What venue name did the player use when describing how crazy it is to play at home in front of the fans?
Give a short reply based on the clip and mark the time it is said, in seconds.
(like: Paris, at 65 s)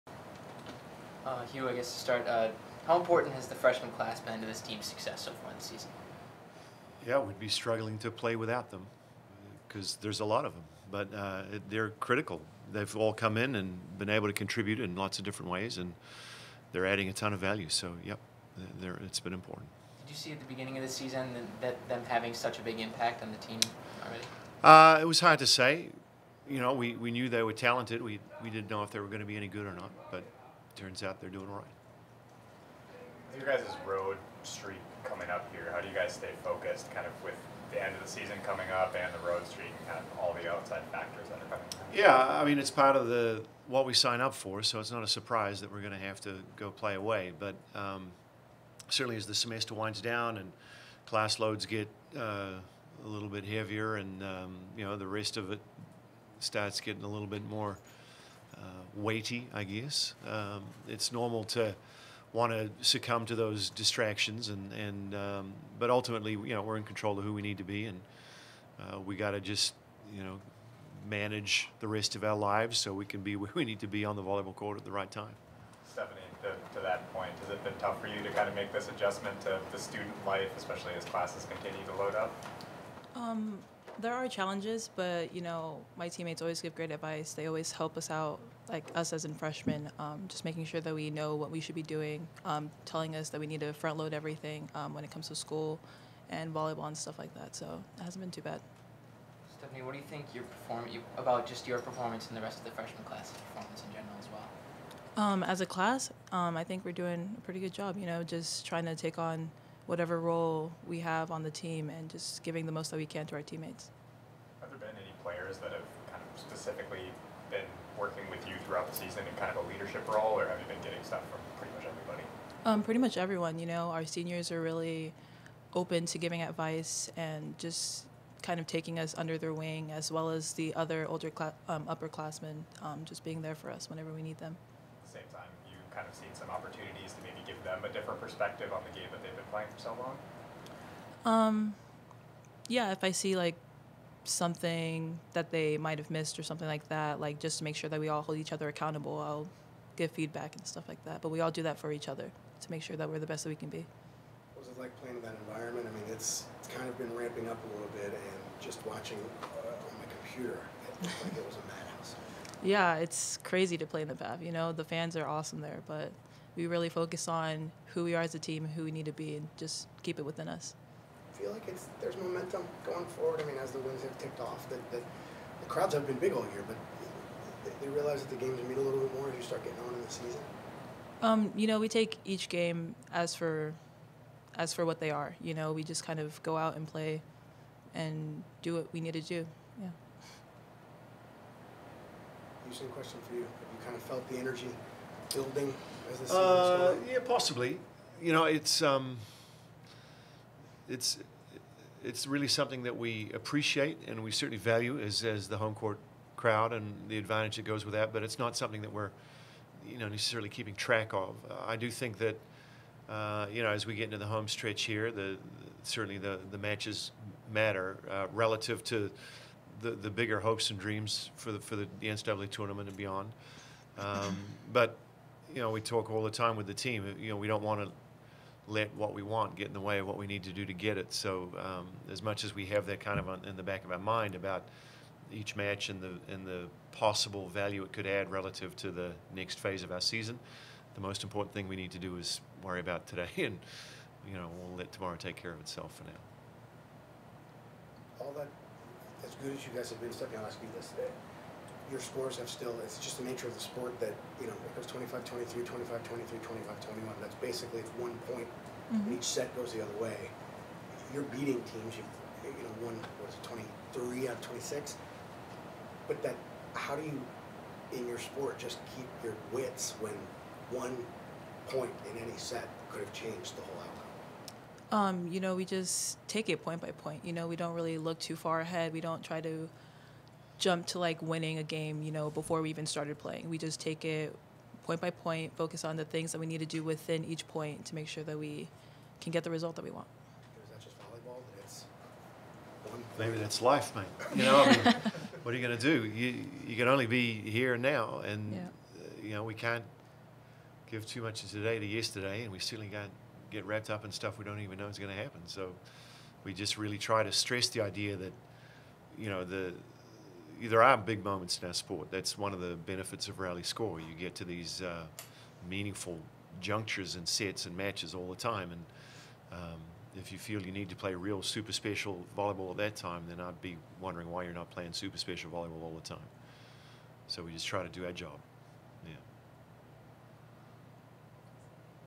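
the Pav, at 164 s.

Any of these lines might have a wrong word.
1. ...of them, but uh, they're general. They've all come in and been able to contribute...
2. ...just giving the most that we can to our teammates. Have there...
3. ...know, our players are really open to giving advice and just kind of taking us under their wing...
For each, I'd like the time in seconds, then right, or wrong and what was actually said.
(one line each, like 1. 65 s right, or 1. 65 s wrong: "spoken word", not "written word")
1. 10 s wrong: "critical", not "general"
2. 112 s right
3. 123 s wrong: "seniors", not "players".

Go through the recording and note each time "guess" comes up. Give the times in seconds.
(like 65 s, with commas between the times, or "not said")
1 s, 59 s.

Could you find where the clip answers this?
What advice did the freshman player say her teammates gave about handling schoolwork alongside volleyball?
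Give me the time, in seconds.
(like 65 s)
93 s.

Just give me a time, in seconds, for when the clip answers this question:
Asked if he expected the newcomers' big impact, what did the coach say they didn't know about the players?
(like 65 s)
28 s.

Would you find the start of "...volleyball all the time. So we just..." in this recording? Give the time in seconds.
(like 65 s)
325 s.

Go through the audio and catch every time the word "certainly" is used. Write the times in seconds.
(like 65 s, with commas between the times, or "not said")
48 s, 204 s, 215 s, 302 s.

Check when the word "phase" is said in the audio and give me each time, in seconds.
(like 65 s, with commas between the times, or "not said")
239 s.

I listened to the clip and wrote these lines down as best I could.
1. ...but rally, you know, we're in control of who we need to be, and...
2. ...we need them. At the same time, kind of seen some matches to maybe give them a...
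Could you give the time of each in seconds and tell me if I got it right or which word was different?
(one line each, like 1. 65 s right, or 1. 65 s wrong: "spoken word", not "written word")
1. 65 s wrong: "ultimately", not "rally"
2. 134 s wrong: "opportunities", not "matches".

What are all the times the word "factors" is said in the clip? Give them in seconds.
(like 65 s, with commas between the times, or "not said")
40 s.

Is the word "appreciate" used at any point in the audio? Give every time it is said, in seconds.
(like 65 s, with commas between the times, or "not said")
203 s.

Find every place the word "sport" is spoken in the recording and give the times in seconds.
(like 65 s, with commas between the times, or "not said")
253 s, 268 s, 311 s.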